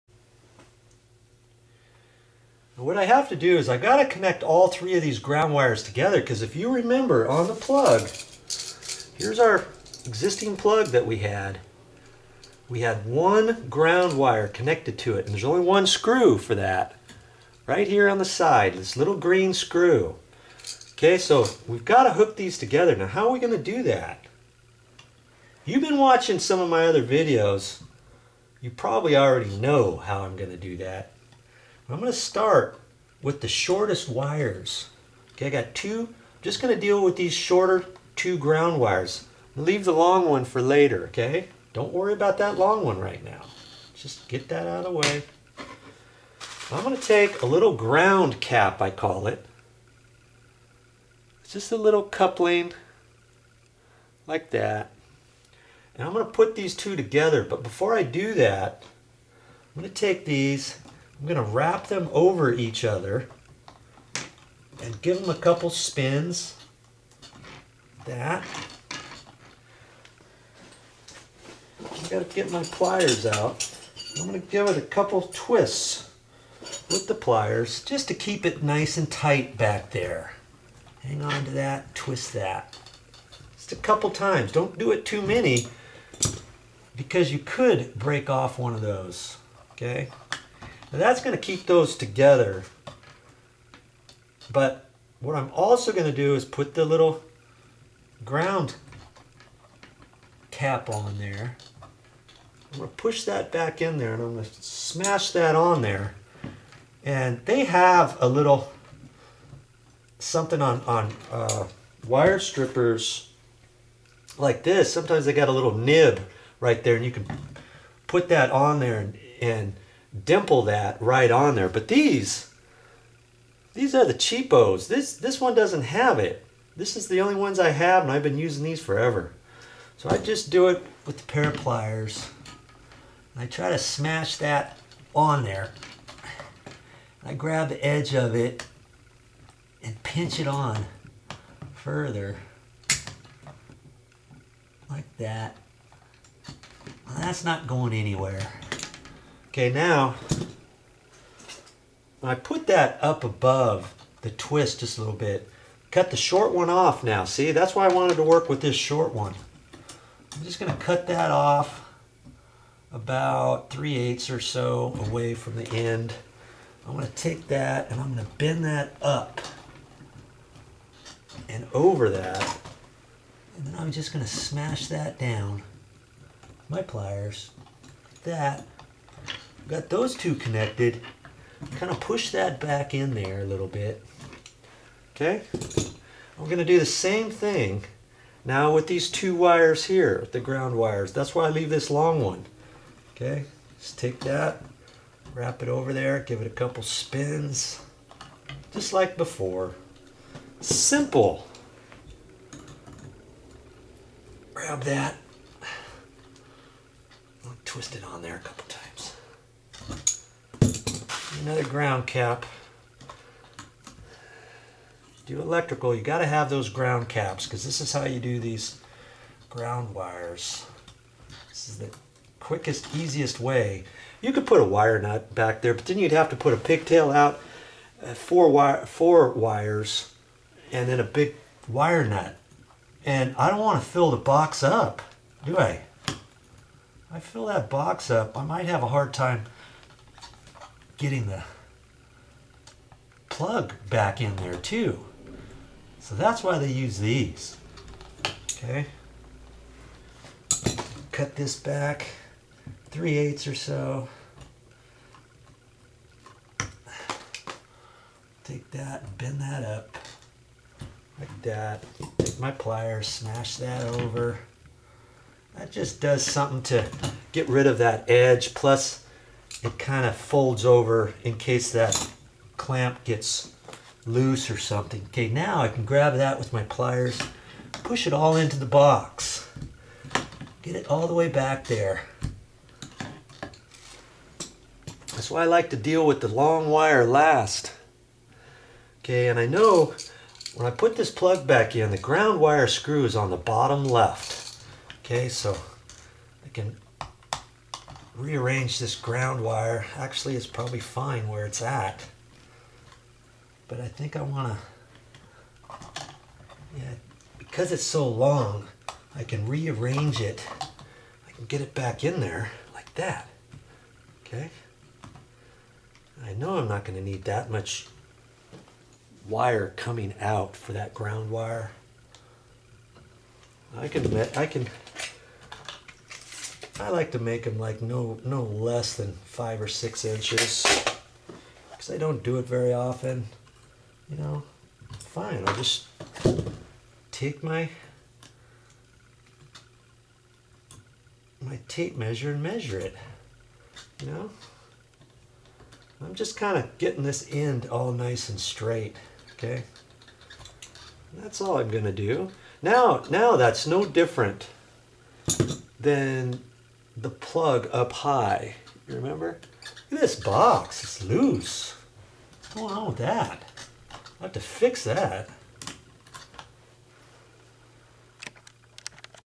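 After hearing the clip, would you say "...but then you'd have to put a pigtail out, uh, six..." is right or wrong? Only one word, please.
wrong.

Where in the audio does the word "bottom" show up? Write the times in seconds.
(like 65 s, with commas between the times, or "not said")
293 s.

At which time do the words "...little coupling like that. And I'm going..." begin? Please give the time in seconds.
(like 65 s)
51 s.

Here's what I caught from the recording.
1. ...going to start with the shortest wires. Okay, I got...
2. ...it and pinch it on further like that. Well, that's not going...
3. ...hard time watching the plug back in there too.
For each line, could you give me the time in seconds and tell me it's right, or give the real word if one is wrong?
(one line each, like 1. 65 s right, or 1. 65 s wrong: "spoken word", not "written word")
1. 31 s right
2. 138 s right
3. 238 s wrong: "getting", not "watching".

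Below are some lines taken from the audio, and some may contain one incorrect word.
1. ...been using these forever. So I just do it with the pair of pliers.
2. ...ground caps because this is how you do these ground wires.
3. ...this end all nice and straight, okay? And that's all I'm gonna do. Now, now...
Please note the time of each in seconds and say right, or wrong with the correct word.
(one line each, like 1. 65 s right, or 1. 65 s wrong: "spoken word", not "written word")
1. 128 s right
2. 216 s right
3. 347 s right.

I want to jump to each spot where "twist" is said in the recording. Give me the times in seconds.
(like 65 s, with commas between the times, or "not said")
75 s, 81 s, 154 s, 207 s.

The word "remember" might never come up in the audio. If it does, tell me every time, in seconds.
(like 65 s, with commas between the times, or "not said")
6 s, 358 s.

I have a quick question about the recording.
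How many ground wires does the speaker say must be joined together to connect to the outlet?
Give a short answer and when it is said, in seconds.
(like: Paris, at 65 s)
3, at 4 s.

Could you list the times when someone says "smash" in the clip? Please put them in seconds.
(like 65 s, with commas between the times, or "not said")
104 s, 133 s, 174 s, 263 s.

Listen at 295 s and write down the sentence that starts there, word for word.
Okay, so I can rearrange this ground wire.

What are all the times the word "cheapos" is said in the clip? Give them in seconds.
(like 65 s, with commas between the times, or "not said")
124 s.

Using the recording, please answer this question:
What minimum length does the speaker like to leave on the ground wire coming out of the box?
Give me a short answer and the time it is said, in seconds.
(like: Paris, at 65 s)
5 or 6 inches, at 329 s.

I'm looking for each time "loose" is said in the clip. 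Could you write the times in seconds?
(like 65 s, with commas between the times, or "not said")
274 s, 361 s.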